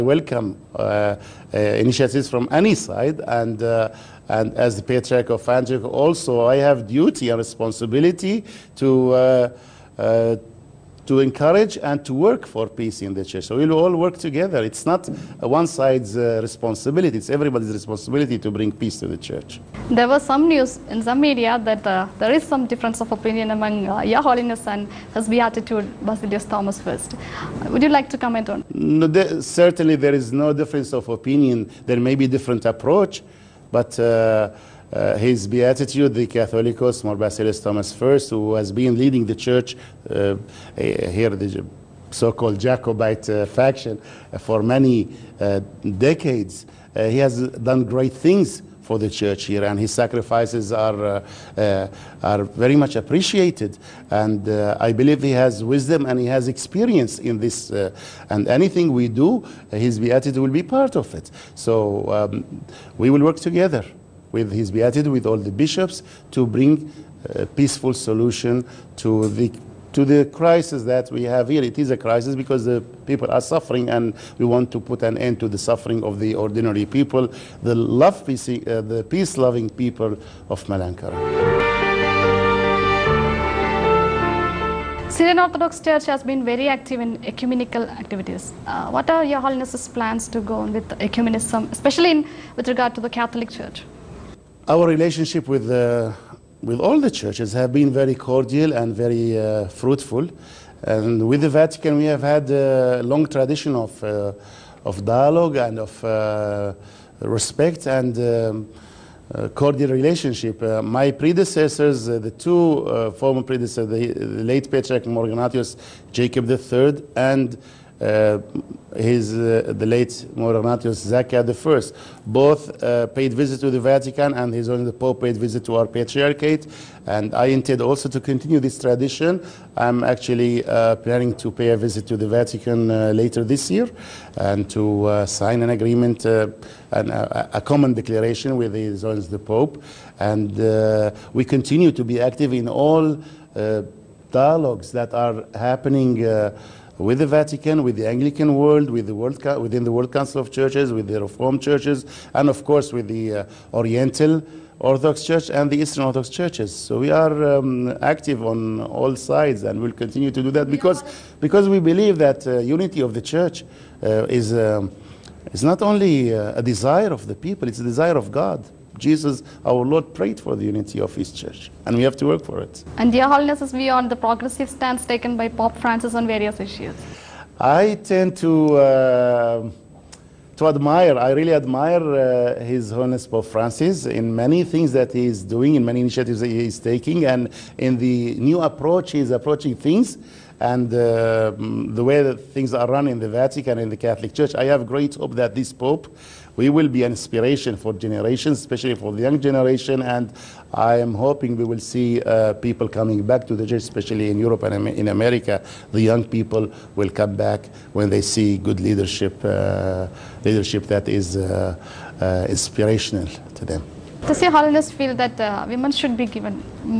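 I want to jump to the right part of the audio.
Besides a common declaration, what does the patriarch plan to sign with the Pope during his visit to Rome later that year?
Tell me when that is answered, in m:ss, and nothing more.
2:15.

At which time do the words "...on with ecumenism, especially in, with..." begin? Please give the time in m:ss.
1:30.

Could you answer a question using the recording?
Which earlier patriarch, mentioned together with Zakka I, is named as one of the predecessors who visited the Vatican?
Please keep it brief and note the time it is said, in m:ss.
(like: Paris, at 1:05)
Ignatius Jacob III, at 1:55.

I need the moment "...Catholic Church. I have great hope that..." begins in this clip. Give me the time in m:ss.
3:13.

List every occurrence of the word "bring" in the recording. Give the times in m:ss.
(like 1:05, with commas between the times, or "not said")
0:18, 1:06.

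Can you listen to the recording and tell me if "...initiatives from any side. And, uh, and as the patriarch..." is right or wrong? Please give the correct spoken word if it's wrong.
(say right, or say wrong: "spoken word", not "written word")
right.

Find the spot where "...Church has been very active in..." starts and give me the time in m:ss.
1:25.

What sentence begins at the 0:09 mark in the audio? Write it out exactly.
Uh, uh to encourage and to work for peace in the church.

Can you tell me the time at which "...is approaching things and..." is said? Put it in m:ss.
3:09.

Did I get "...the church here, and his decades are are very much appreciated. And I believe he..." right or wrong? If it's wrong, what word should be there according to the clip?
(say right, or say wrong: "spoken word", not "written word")
wrong: "sacrifices", not "decades".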